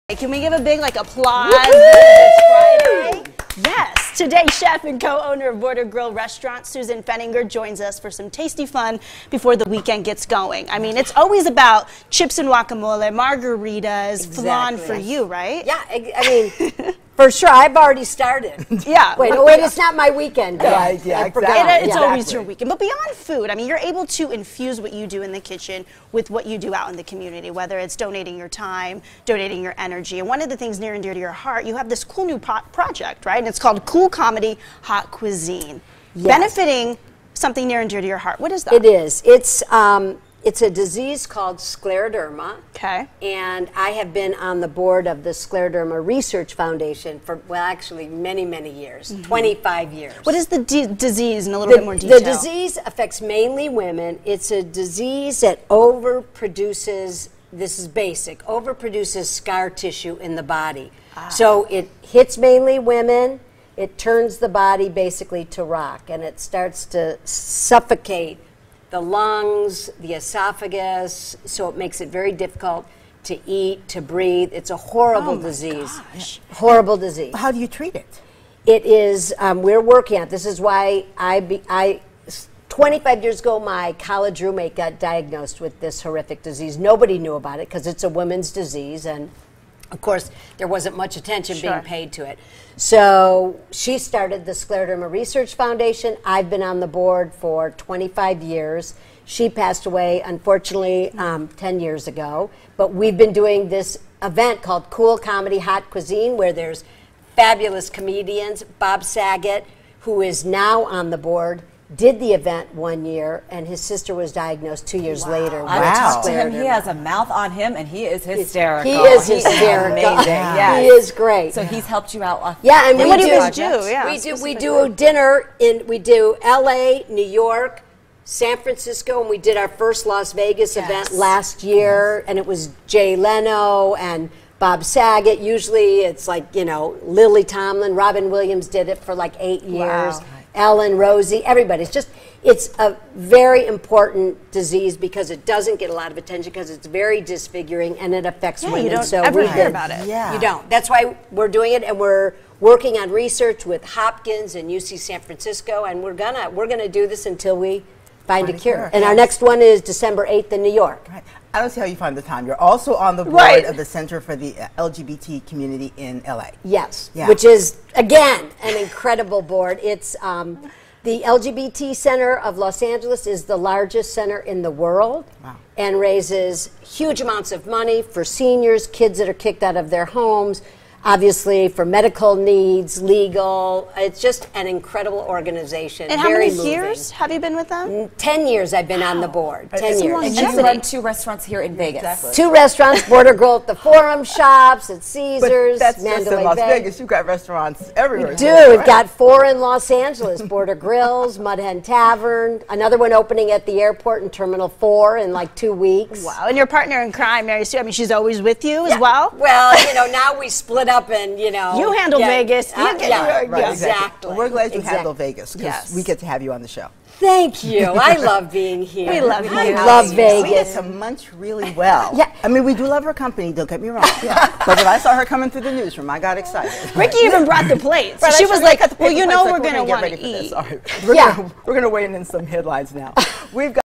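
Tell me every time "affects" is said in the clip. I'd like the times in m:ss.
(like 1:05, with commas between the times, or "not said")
0:52, 2:28.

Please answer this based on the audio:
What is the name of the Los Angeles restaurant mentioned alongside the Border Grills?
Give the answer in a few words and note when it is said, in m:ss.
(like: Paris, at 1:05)
Mud Hen Tavern, at 3:21.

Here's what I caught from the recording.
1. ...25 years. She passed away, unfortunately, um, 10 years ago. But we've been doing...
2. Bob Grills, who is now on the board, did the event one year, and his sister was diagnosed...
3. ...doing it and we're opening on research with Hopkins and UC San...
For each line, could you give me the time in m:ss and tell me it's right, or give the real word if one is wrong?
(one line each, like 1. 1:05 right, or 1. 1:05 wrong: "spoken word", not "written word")
1. 1:37 right
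2. 1:48 wrong: "Saget", not "Grills"
3. 2:31 wrong: "working", not "opening".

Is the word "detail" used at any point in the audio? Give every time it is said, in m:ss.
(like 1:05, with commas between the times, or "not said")
0:51.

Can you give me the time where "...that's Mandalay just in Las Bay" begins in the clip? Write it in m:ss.
3:15.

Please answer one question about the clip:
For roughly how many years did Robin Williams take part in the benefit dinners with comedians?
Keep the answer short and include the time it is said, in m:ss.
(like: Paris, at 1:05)
8, at 2:19.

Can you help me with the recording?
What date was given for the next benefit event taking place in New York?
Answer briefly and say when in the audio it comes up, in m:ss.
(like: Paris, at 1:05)
December 8th, at 2:39.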